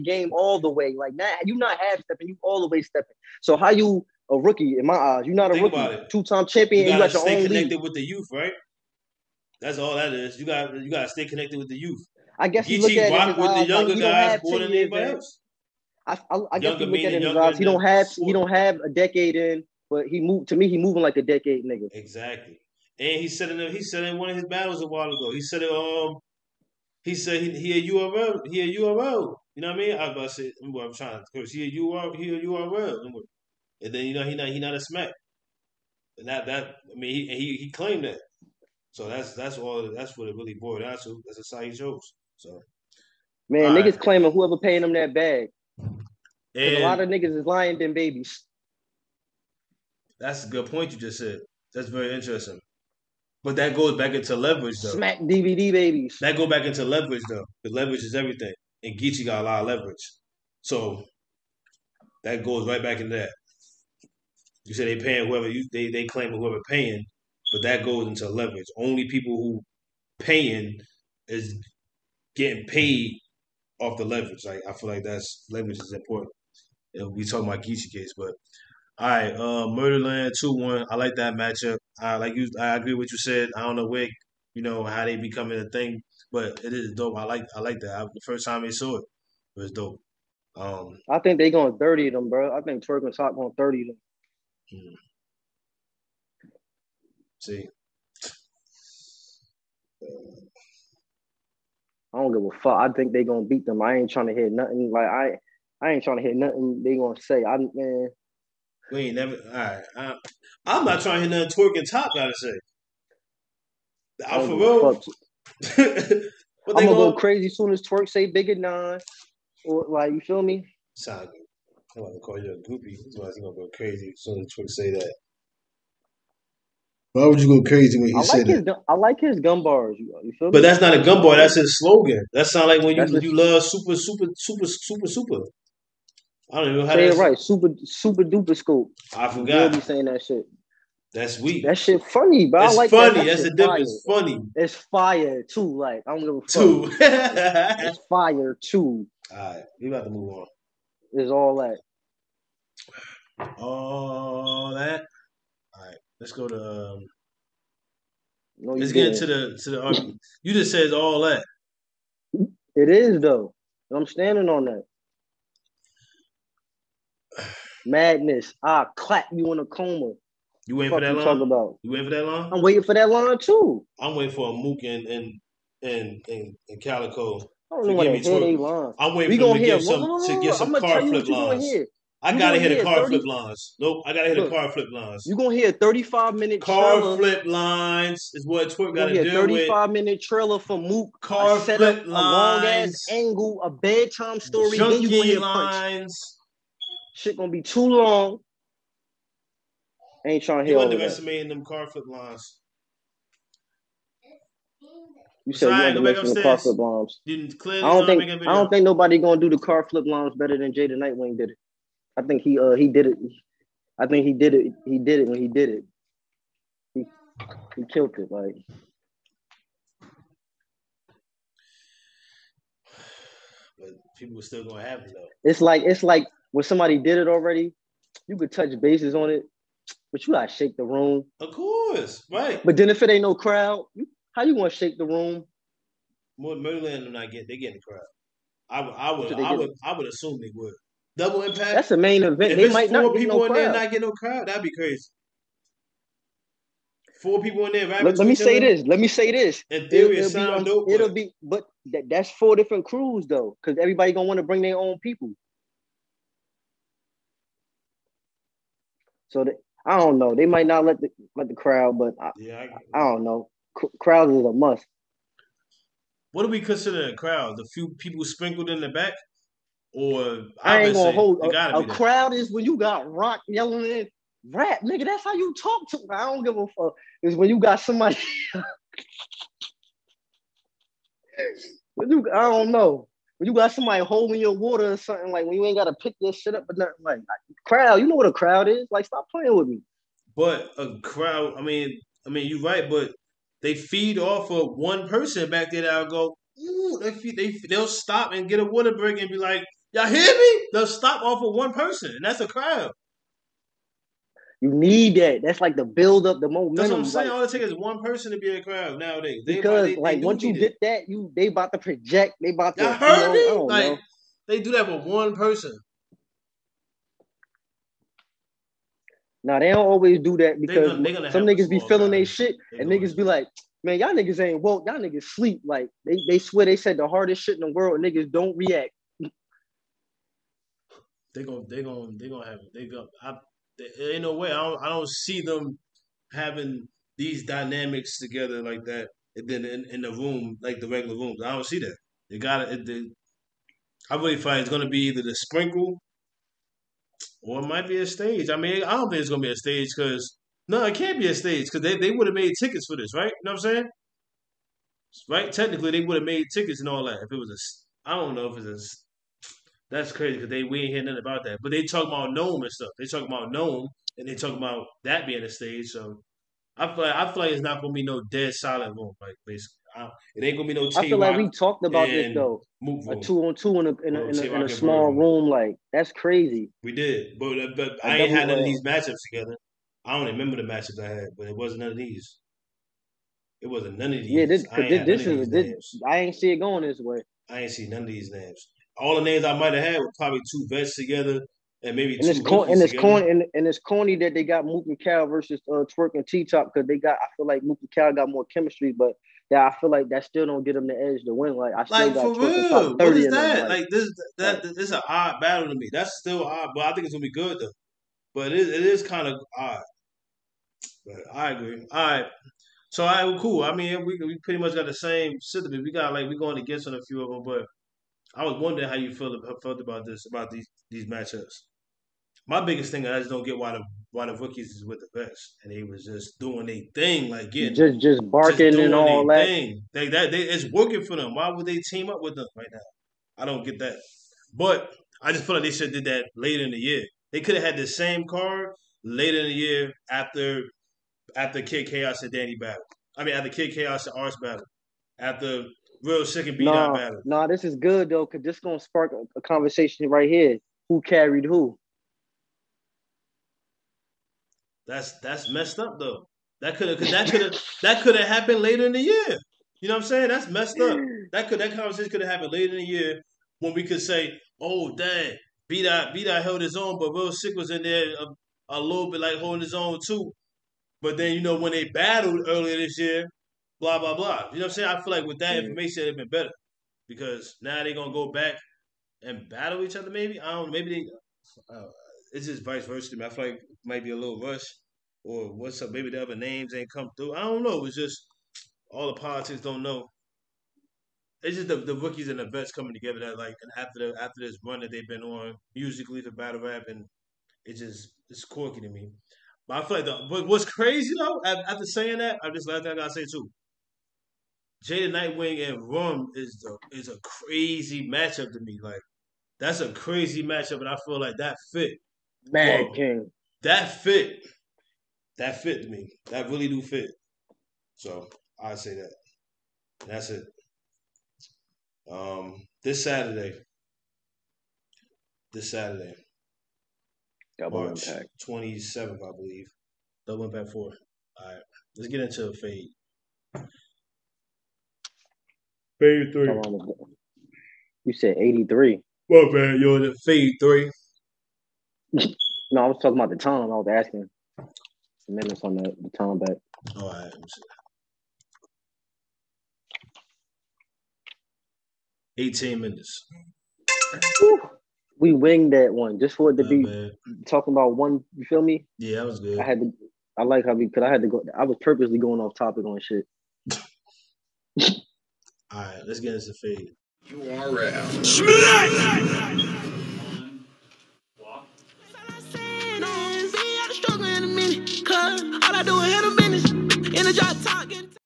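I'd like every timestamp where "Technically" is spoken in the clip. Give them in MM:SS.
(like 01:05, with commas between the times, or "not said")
05:55.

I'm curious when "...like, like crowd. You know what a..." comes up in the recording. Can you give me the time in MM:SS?
04:47.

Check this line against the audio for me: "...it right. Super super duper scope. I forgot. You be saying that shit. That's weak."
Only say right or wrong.
right.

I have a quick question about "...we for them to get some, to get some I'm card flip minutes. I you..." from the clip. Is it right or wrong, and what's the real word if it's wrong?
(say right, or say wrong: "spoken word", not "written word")
wrong: "lines", not "minutes".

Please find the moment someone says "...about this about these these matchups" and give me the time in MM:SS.
06:59.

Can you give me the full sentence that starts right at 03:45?
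It's like it's like when somebody did it already, you could touch bases on it, but you gotta shake the room.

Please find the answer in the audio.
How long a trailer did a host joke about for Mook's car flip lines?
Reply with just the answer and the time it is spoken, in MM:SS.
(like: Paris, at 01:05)
35 minutes, at 03:05.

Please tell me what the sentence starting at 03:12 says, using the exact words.
A long ass angle, a bedtime story.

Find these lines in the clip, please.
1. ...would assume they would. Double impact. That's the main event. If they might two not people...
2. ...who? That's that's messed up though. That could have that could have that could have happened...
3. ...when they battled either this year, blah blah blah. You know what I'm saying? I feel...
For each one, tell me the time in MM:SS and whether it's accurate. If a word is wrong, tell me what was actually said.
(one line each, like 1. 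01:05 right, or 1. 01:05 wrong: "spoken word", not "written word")
1. 03:59 wrong: "four", not "two"
2. 07:31 right
3. 07:51 wrong: "earlier", not "either".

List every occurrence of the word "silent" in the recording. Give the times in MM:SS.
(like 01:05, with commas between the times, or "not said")
06:08.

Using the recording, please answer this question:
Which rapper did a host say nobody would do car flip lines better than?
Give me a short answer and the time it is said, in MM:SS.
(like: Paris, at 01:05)
Jada Nightwing, at 03:30.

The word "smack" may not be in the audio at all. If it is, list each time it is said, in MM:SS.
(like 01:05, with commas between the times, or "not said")
00:34, 00:54.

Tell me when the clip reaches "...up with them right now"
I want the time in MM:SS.
07:12.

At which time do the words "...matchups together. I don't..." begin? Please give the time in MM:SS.
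06:18.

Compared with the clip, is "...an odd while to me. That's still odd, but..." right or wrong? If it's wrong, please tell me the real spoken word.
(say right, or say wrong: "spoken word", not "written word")
wrong: "battle", not "while".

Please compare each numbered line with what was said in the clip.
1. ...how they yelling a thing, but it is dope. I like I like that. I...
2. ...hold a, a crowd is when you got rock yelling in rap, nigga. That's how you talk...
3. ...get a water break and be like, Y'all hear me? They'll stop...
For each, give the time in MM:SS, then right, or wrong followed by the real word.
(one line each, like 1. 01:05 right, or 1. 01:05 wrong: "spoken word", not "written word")
1. 01:24 wrong: "becoming", not "yelling"
2. 04:31 right
3. 04:58 right.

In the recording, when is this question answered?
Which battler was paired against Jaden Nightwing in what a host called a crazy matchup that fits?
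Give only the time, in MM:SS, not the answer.
08:25.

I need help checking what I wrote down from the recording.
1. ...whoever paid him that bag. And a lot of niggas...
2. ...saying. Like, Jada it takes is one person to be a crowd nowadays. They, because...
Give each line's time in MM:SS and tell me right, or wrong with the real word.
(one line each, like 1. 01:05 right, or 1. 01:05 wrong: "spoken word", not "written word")
1. 00:44 right
2. 05:07 wrong: "All", not "Jada".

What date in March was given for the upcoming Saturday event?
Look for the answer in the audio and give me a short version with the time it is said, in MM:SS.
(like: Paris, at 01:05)
March 27, at 08:48.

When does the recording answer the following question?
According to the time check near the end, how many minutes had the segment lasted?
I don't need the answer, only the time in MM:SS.
09:12.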